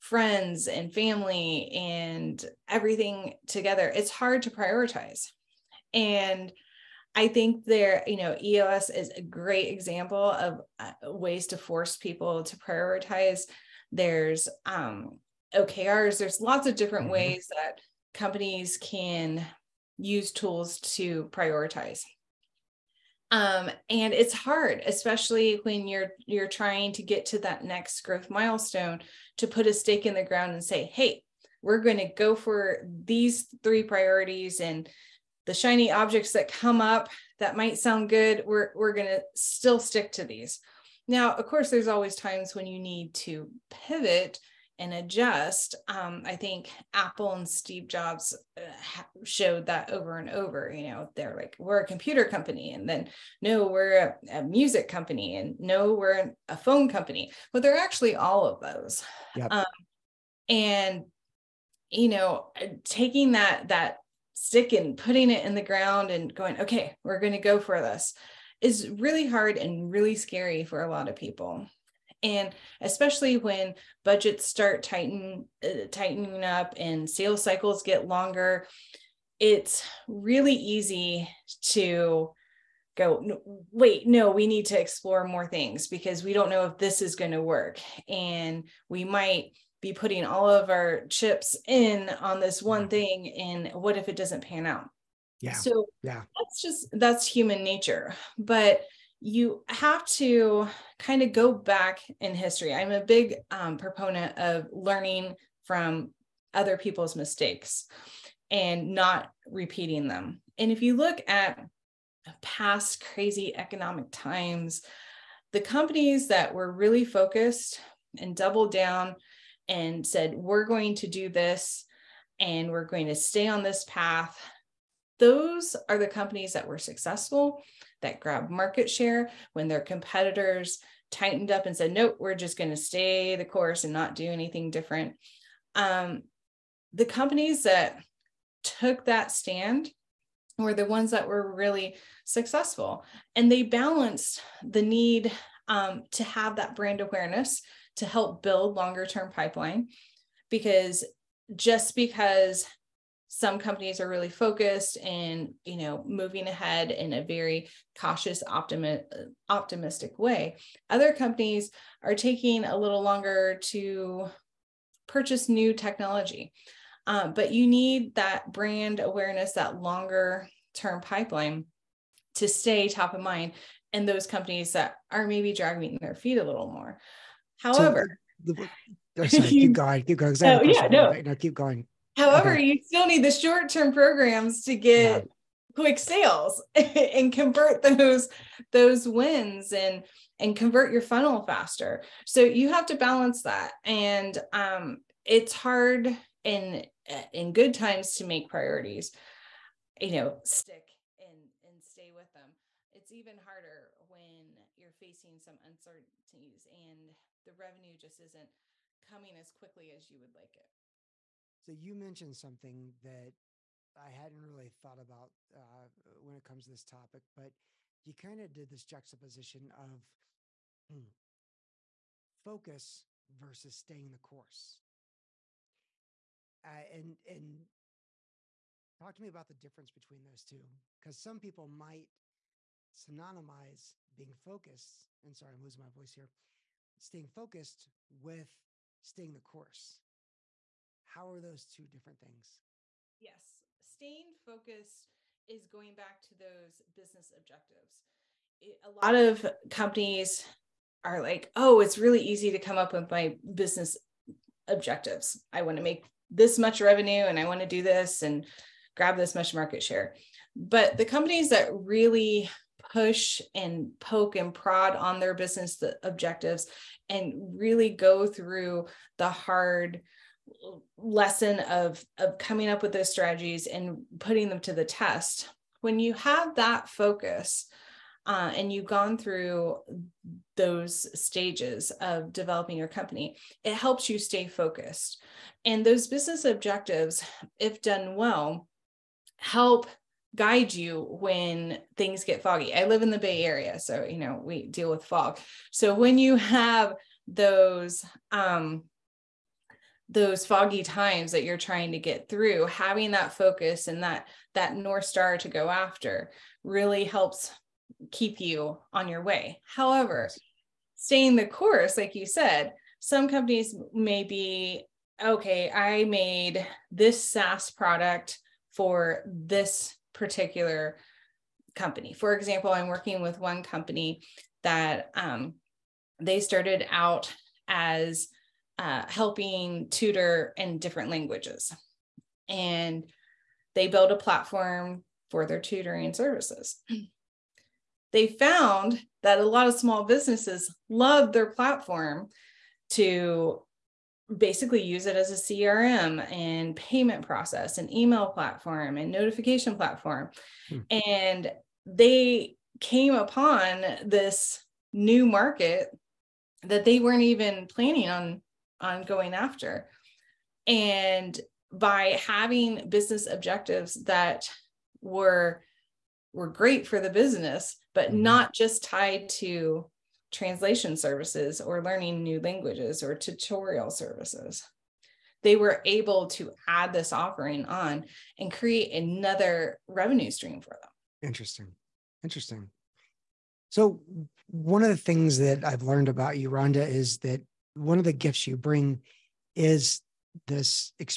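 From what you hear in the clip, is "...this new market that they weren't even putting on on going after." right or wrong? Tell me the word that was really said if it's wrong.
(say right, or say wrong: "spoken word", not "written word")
wrong: "planning", not "putting".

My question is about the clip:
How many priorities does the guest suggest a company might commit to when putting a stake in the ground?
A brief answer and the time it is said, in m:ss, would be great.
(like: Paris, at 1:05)
3, at 0:33.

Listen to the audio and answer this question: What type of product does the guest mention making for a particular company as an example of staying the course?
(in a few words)
SaaS product.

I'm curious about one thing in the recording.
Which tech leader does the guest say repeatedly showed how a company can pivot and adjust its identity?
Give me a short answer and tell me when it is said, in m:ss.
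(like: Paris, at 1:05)
Steve Jobs, at 0:47.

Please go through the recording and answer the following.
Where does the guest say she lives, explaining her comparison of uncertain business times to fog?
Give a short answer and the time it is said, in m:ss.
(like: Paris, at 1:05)
the Bay Area, at 4:53.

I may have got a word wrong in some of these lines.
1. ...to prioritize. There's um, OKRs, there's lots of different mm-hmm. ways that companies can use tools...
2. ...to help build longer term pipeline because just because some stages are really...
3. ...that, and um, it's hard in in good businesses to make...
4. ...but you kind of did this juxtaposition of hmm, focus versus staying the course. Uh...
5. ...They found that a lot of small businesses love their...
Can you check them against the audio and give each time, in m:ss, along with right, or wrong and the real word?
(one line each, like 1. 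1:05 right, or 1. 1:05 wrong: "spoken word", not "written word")
1. 0:12 right
2. 2:27 wrong: "companies", not "stages"
3. 3:13 wrong: "times", not "businesses"
4. 3:37 right
5. 5:38 right.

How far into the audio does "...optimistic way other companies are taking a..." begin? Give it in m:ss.
2:39.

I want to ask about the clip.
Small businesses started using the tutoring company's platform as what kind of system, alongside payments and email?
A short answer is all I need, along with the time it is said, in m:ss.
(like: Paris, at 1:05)
CRM, at 5:45.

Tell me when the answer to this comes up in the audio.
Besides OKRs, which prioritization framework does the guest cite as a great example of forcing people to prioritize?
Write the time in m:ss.
0:08.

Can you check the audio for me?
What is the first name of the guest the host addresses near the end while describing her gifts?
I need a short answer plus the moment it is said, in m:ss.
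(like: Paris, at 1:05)
Rhonda, at 6:26.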